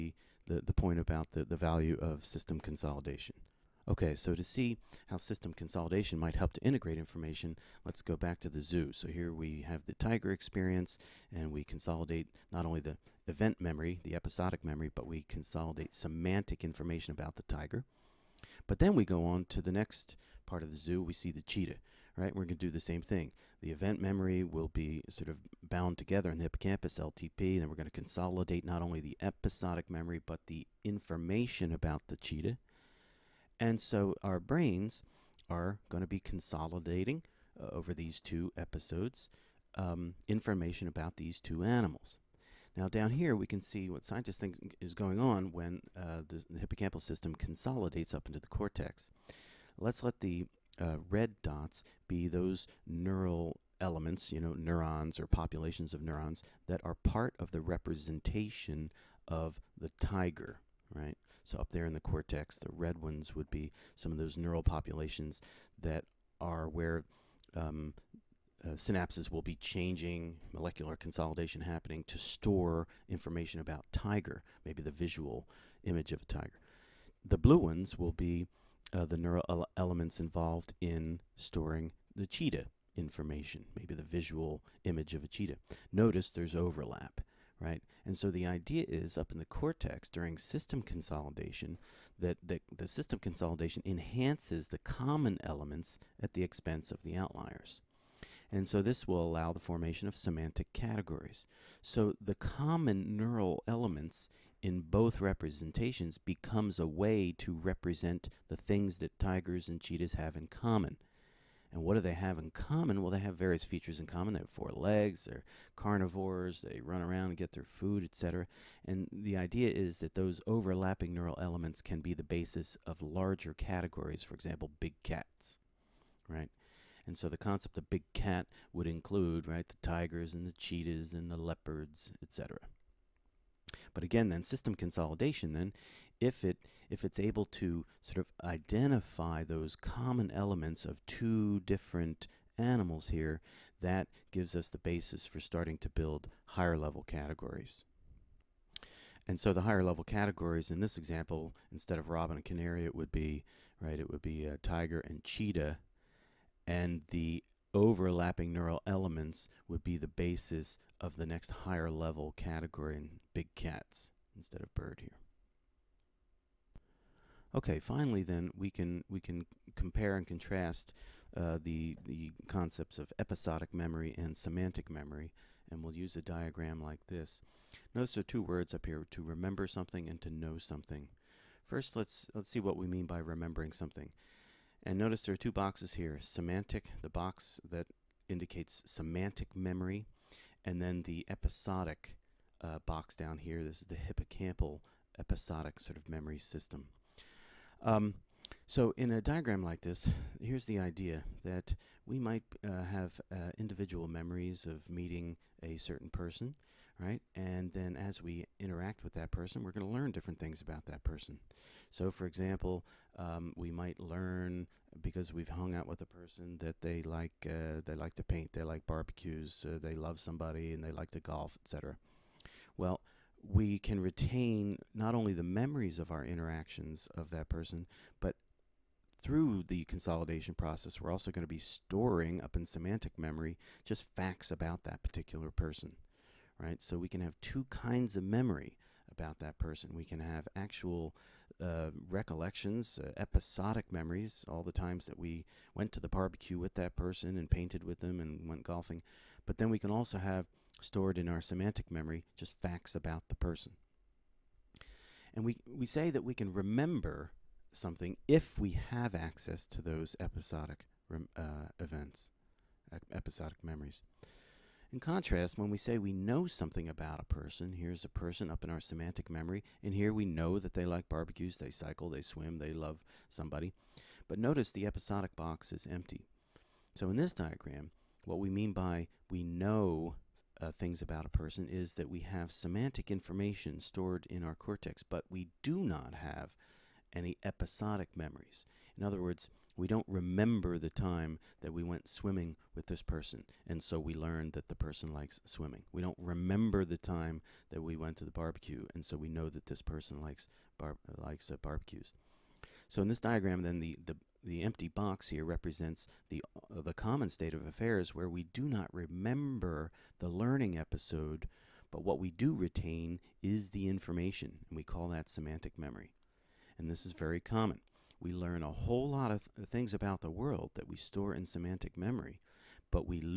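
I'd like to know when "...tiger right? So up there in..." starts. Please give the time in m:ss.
0:59.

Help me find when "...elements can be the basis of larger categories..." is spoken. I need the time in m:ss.
2:01.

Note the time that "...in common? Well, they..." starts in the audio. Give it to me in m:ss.
1:52.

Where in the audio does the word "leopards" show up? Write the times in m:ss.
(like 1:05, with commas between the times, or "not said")
2:11.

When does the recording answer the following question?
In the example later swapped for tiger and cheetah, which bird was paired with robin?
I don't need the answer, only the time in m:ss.
2:32.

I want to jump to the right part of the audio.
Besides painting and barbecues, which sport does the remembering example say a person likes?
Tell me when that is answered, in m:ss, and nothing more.
3:41.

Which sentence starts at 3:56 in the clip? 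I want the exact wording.
So we can have two kinds of memory about that person.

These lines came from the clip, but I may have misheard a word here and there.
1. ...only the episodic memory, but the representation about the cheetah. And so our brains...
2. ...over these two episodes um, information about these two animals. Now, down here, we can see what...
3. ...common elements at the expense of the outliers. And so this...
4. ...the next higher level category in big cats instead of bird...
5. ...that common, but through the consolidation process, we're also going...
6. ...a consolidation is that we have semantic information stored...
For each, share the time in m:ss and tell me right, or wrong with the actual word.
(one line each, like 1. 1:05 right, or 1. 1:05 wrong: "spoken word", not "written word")
1. 0:28 wrong: "information", not "representation"
2. 0:37 right
3. 1:34 right
4. 2:41 right
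5. 3:47 wrong: "person", not "common"
6. 4:41 wrong: "person", not "consolidation".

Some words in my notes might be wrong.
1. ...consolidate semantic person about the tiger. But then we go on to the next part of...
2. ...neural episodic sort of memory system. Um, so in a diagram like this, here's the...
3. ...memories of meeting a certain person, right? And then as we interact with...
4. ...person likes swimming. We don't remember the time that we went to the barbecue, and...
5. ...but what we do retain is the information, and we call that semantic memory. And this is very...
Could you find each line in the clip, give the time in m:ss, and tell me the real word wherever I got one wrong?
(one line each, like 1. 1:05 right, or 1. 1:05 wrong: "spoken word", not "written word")
1. 0:15 wrong: "information", not "person"
2. 3:13 wrong: "hippocampal", not "neural"
3. 3:24 right
4. 4:54 right
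5. 5:11 right.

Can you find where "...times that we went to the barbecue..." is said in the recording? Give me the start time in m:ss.
4:04.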